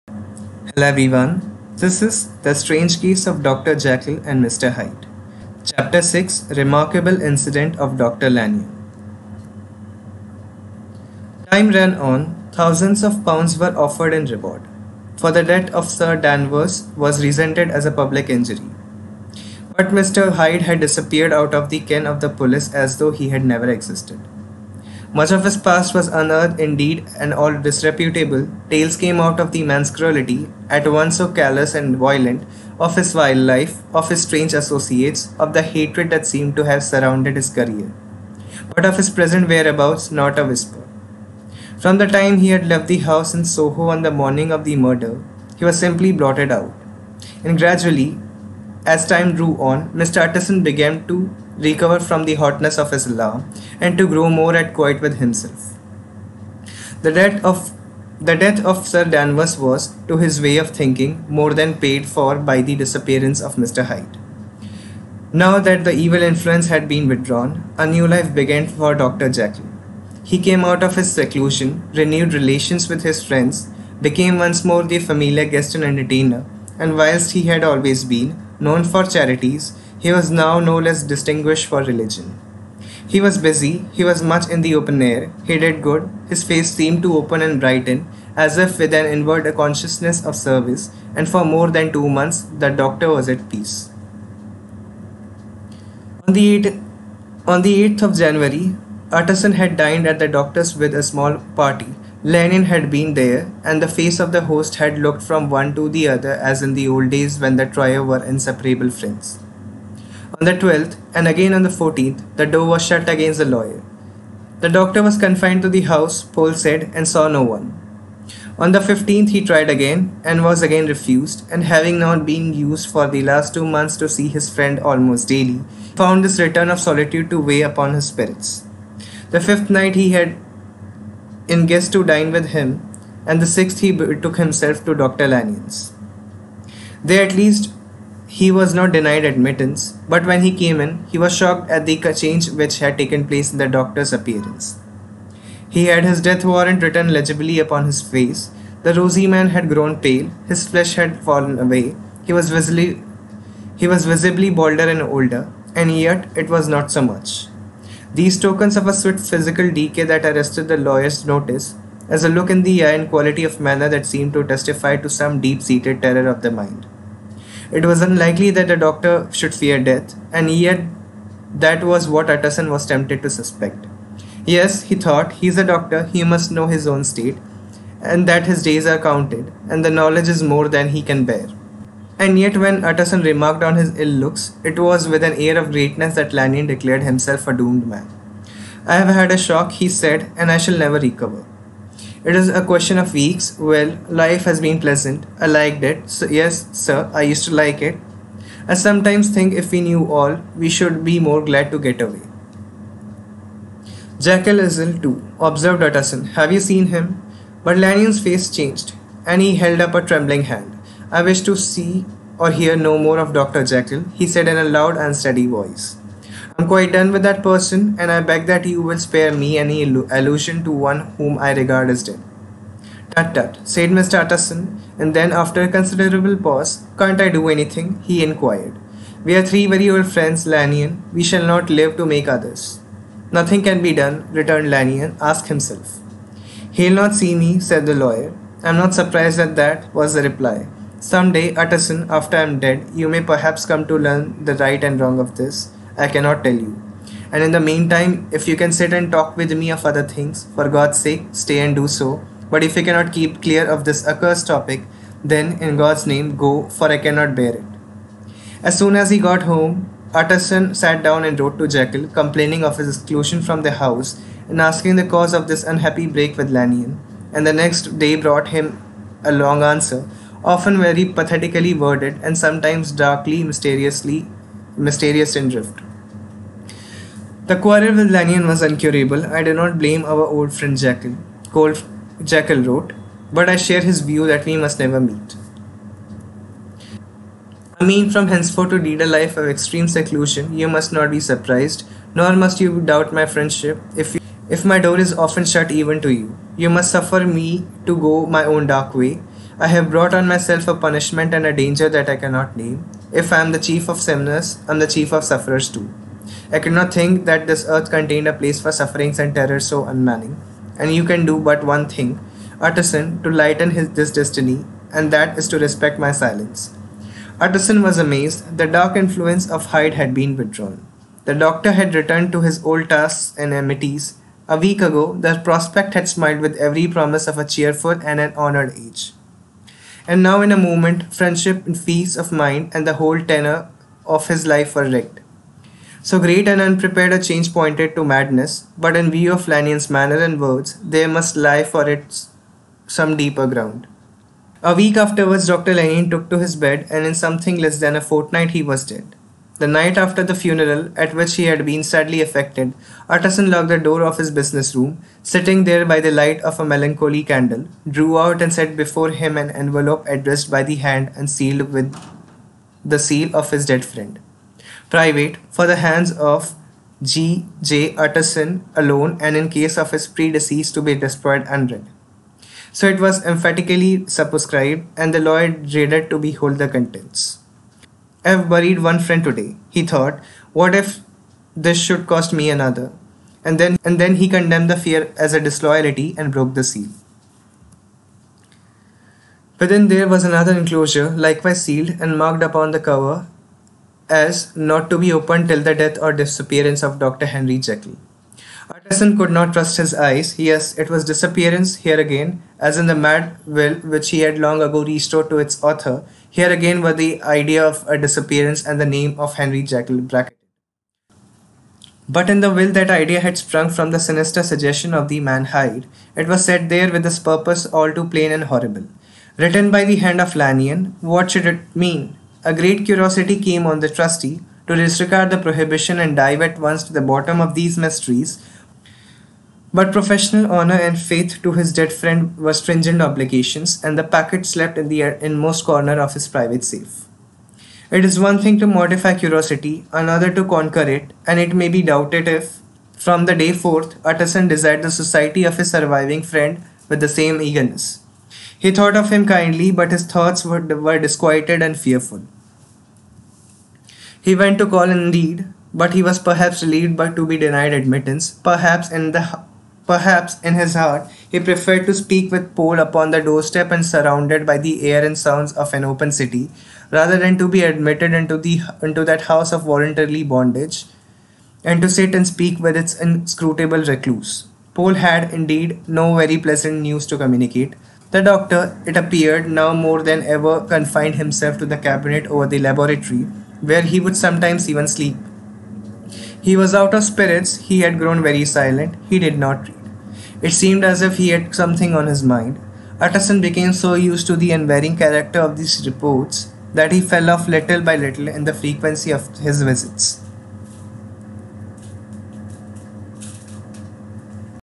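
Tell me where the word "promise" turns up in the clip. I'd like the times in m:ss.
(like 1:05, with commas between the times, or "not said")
5:26.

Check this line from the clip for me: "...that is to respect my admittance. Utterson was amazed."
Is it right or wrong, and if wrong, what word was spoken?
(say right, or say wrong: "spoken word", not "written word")
wrong: "silence", not "admittance".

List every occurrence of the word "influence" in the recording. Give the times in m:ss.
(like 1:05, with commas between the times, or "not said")
1:06, 5:18.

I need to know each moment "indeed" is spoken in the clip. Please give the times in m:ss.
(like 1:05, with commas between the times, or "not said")
0:26, 7:34, 7:55.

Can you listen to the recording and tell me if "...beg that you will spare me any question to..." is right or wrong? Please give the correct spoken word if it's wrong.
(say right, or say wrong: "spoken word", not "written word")
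wrong: "allusion", not "question".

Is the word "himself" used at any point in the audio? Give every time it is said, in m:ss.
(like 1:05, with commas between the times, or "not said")
0:55, 2:14, 3:07, 3:55, 8:01.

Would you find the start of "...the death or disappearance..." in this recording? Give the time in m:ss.
6:35.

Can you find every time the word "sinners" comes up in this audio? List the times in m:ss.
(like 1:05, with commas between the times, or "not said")
5:03.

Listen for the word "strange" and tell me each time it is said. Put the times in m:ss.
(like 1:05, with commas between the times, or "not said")
0:02, 0:34.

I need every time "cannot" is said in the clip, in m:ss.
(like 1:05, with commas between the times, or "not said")
4:06, 4:12, 4:16, 5:02.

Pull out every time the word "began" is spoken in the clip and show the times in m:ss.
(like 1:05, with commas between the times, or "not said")
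0:50, 1:08.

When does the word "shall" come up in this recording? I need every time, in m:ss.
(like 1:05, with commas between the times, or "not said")
3:10, 3:51.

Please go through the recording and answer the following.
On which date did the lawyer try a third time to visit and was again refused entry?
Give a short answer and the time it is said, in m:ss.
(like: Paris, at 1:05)
15th, at 1:58.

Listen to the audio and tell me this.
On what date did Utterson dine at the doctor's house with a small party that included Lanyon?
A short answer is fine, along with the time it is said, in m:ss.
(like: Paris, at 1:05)
8th of January, at 1:37.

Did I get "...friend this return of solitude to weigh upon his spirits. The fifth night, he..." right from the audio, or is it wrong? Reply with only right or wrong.
wrong.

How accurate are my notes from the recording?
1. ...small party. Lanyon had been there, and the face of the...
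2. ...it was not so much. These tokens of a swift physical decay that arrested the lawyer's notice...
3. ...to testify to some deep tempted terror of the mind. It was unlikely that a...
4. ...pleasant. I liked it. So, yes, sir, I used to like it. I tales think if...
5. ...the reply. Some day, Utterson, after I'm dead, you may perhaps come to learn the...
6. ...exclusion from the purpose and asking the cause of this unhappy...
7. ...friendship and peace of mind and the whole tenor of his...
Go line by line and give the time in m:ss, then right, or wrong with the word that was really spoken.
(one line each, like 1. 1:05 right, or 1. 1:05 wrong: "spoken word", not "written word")
1. 1:41 right
2. 2:36 right
3. 2:44 wrong: "seated", not "tempted"
4. 3:14 wrong: "sometimes", not "tales"
5. 4:00 right
6. 4:22 wrong: "house", not "purpose"
7. 5:31 right.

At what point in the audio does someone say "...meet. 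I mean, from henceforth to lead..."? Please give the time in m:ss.
4:45.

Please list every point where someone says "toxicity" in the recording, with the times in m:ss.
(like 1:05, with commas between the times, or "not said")
not said.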